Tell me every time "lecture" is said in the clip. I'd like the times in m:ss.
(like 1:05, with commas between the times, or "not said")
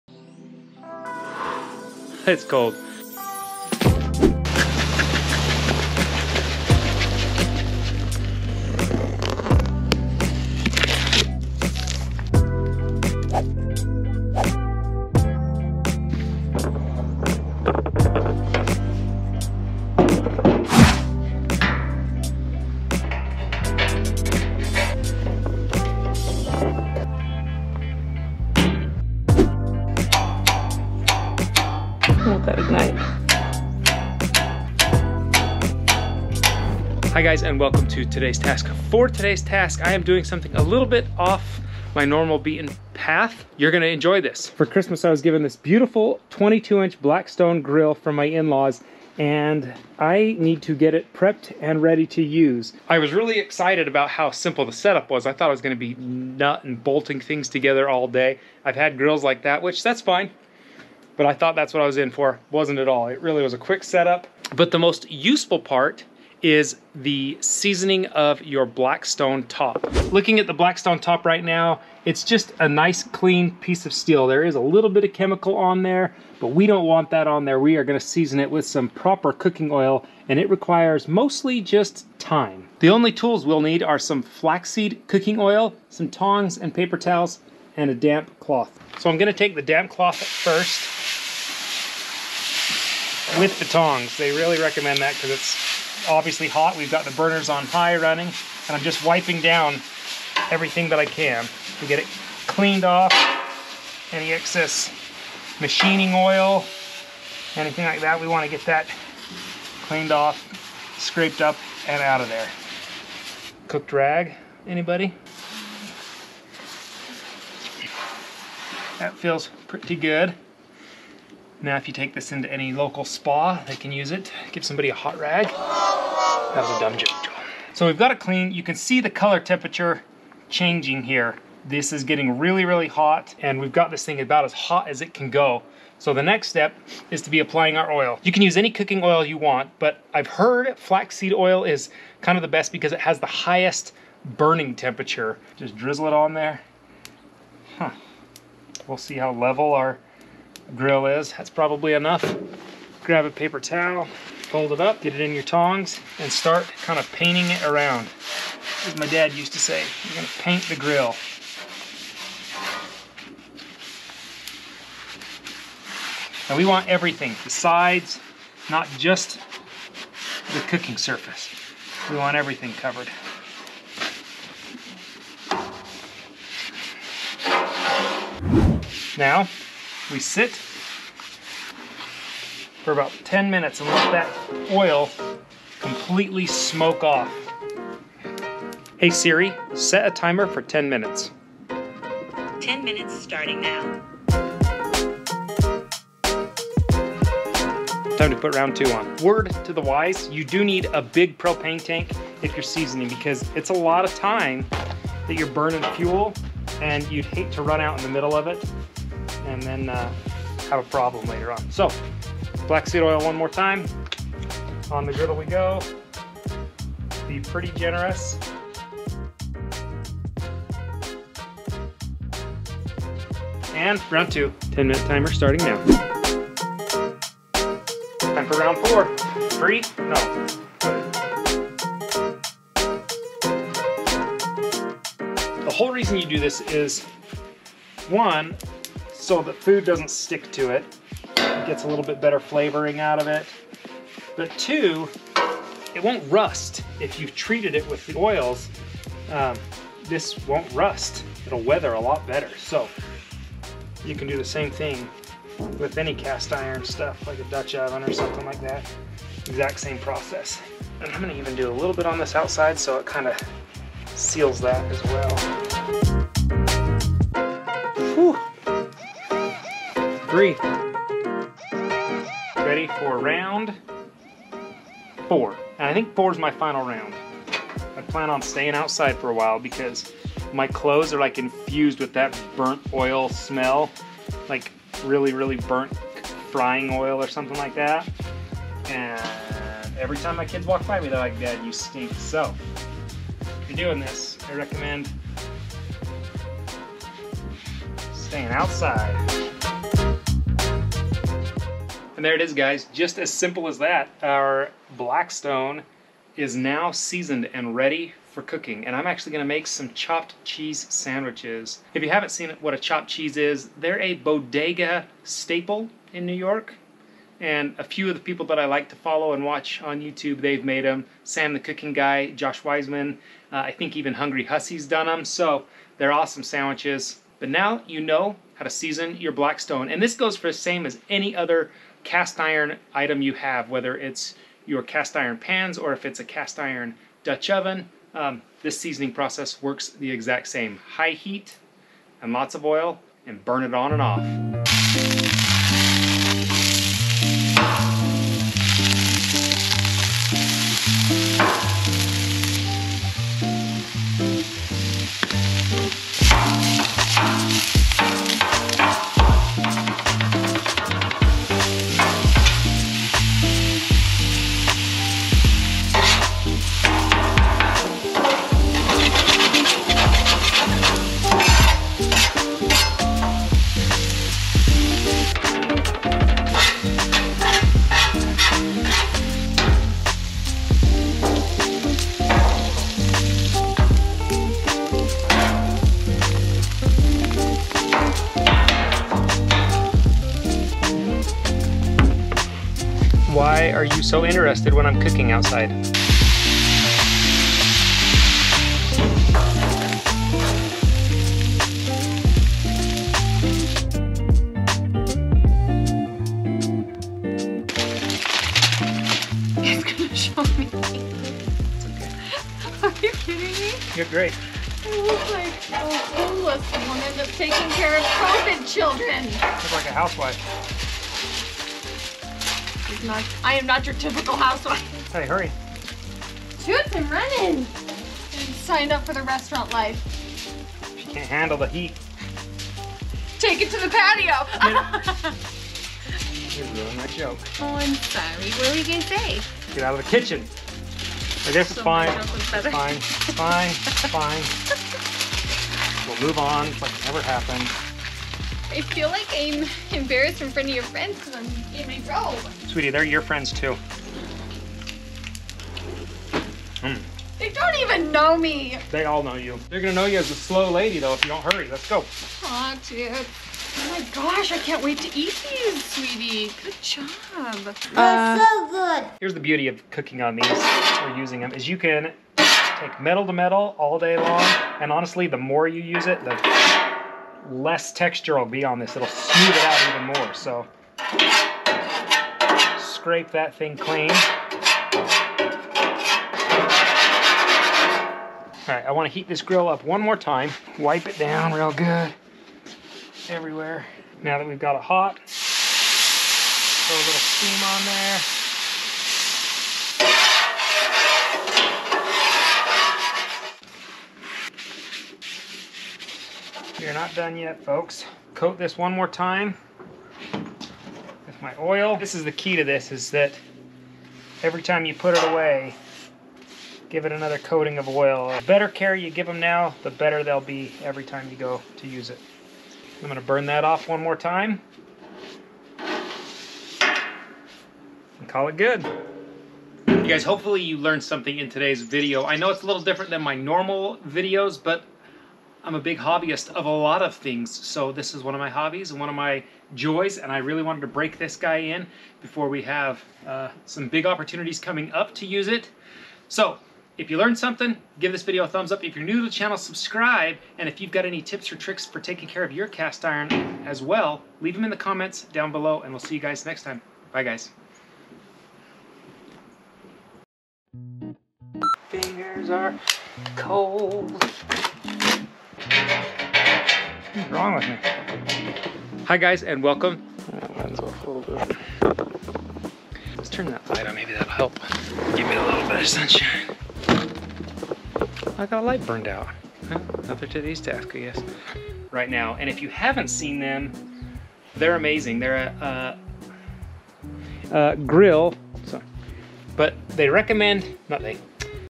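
not said.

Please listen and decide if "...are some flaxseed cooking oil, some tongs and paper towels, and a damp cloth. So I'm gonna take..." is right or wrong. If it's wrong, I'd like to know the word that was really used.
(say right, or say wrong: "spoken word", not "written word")
right.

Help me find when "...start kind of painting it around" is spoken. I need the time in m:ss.
2:36.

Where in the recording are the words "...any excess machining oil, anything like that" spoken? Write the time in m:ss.
1:44.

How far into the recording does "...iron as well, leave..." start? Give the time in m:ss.
9:13.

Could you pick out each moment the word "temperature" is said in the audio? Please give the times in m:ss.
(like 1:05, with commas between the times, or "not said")
2:09, 2:24.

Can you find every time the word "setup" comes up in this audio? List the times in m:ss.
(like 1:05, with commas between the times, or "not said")
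0:54, 1:03.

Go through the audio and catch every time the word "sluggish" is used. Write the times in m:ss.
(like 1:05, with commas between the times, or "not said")
not said.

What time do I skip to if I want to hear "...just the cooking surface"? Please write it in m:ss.
2:48.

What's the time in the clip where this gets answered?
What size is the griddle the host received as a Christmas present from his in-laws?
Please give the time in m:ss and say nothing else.
0:46.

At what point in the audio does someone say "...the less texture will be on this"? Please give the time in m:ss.
7:56.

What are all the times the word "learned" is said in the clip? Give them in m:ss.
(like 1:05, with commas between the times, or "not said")
8:50, 9:07.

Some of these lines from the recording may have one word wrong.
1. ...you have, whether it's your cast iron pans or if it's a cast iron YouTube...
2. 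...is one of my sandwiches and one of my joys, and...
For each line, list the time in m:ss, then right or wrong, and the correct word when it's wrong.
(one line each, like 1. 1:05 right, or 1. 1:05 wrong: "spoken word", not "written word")
1. 5:33 wrong: "Dutch", not "YouTube"
2. 8:58 wrong: "hobbies", not "sandwiches".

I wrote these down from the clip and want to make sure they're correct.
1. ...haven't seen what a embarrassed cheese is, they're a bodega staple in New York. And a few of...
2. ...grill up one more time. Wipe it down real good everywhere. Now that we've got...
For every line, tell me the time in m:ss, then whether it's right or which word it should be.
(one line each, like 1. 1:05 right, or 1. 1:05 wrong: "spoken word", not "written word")
1. 5:12 wrong: "chopped", not "embarrassed"
2. 8:09 right.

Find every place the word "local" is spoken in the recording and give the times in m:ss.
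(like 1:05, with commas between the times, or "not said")
2:02.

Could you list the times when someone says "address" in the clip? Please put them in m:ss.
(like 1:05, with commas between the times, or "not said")
not said.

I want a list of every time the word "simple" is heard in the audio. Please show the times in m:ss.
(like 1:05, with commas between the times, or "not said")
0:54, 5:03.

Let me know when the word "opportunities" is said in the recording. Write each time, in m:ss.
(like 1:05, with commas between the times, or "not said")
9:04.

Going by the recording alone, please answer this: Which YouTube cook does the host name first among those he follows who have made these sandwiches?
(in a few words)
Sam the Cooking Guy.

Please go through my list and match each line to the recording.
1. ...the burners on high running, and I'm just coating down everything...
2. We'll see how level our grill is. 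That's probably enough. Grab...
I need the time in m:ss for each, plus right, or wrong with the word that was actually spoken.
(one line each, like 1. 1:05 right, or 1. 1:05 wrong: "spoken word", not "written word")
1. 1:37 wrong: "wiping", not "coating"
2. 2:28 right.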